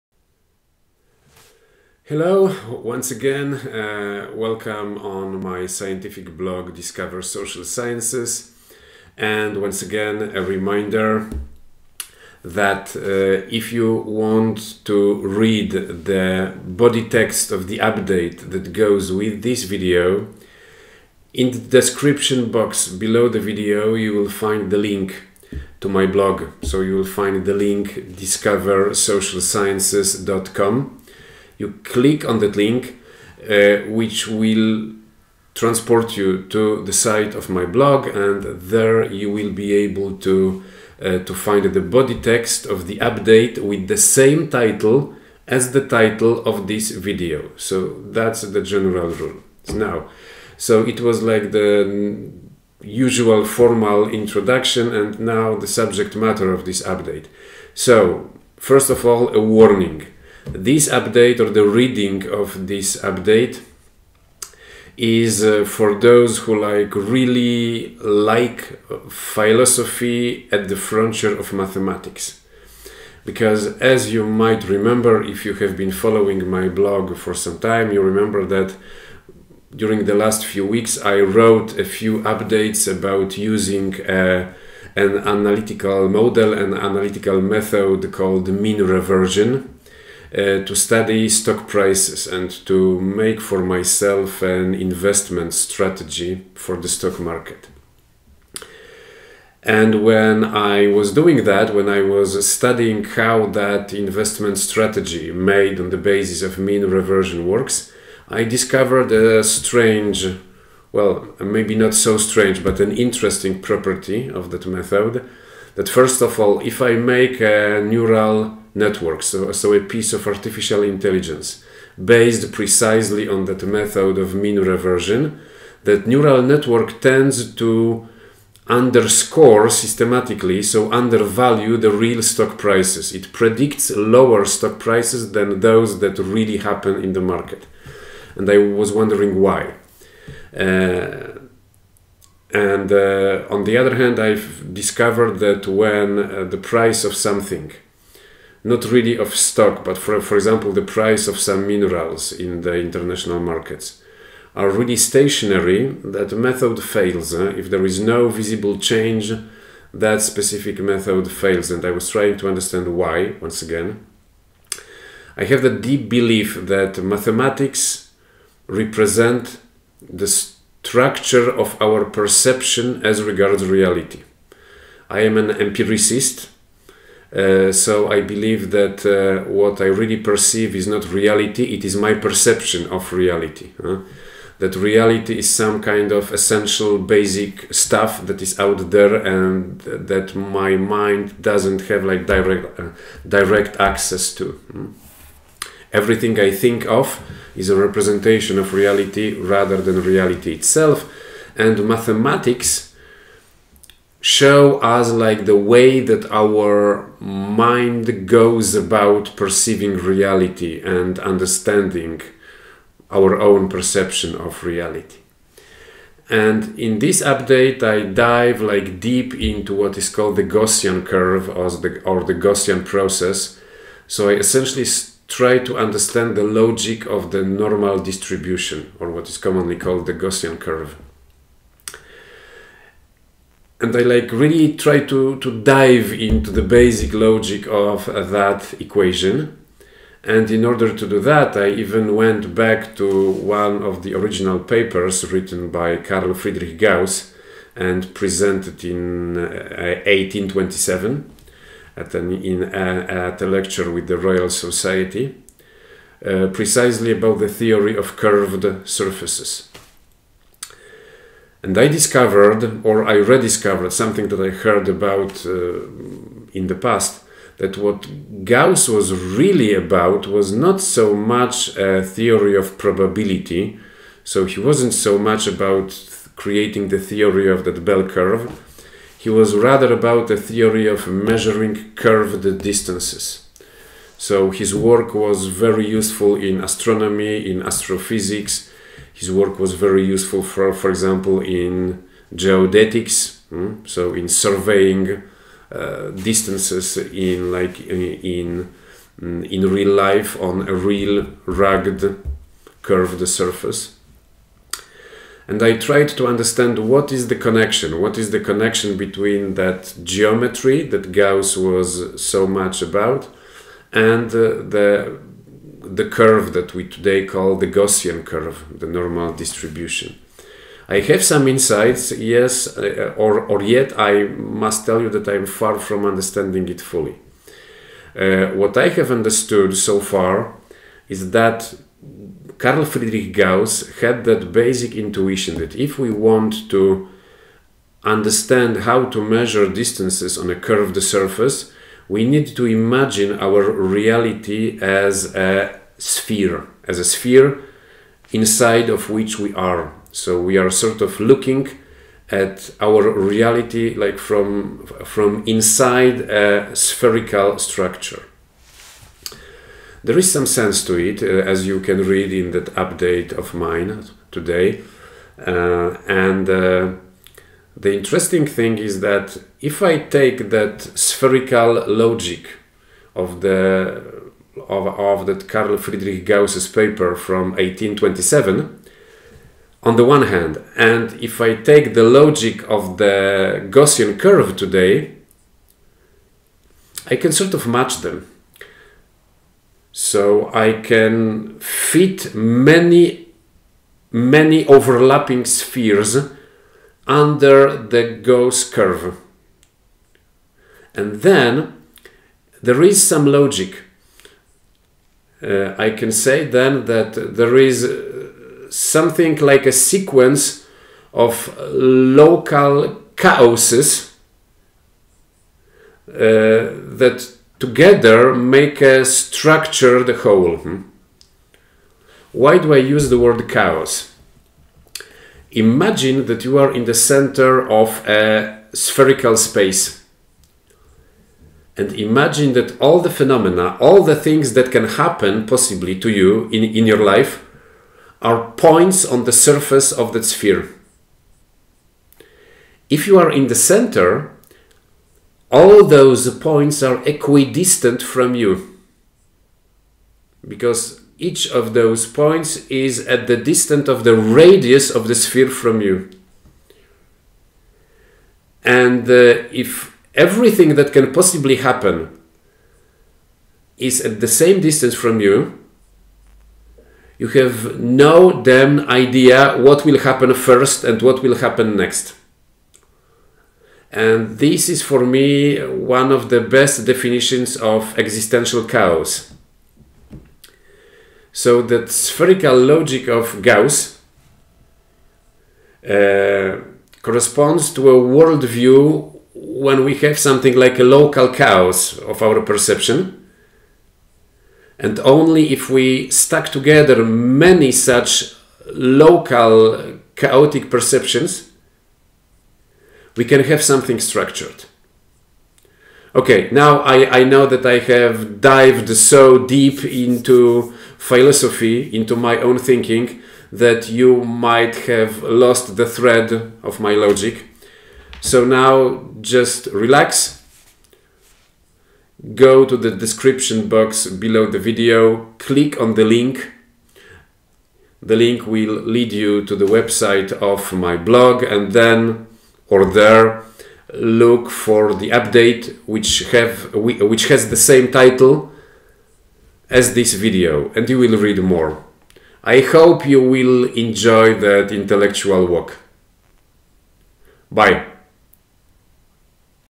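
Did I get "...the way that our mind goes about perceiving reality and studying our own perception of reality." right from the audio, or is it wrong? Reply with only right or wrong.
wrong.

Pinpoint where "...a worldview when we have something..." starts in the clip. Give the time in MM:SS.
08:07.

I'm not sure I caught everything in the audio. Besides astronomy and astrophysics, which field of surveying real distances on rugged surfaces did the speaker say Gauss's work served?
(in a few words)
geodetics.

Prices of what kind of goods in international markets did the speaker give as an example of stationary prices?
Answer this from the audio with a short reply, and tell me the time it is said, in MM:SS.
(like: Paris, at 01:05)
minerals, at 02:31.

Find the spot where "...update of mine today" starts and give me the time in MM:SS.
06:02.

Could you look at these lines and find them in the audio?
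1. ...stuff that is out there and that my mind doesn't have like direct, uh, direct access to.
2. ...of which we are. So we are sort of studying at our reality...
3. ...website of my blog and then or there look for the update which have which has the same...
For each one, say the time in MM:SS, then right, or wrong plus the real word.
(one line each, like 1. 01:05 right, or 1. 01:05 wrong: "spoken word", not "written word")
1. 03:07 right
2. 05:48 wrong: "looking", not "studying"
3. 08:49 right.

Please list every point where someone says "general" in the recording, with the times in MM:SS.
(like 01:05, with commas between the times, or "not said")
00:48.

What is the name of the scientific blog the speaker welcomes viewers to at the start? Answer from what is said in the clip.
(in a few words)
Discover Social Sciences.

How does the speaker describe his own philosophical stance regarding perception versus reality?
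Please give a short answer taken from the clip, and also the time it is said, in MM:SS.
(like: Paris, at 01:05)
empiricist, at 02:55.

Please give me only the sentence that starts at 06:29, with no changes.
So I can fit many, many overlapping spheres under the Gauss curve.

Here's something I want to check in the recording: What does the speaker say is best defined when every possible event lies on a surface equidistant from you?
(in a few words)
existential chaos.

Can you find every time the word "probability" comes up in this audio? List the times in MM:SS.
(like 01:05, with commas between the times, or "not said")
04:32.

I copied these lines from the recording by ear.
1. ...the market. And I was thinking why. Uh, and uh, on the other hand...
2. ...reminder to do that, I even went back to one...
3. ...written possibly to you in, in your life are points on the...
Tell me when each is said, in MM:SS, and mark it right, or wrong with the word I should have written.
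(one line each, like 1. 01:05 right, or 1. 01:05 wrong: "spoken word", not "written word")
1. 02:17 wrong: "wondering", not "thinking"
2. 04:00 wrong: "order", not "reminder"
3. 07:14 wrong: "happen", not "written".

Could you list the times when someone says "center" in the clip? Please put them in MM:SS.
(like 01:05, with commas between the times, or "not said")
07:06, 07:23.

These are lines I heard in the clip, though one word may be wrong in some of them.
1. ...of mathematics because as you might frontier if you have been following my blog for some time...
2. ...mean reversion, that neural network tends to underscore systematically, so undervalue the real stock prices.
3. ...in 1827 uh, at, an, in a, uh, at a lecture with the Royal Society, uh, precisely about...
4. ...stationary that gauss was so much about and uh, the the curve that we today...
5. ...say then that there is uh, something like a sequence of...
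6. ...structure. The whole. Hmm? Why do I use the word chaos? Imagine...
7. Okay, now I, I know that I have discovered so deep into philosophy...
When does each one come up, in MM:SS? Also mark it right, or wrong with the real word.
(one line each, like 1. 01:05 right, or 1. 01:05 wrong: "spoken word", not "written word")
1. 01:11 wrong: "remember", not "frontier"
2. 02:04 right
3. 04:08 right
4. 05:10 wrong: "geometry", not "stationary"
5. 06:46 right
6. 06:59 right
7. 08:26 wrong: "dived", not "discovered".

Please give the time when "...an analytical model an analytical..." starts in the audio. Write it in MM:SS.
01:24.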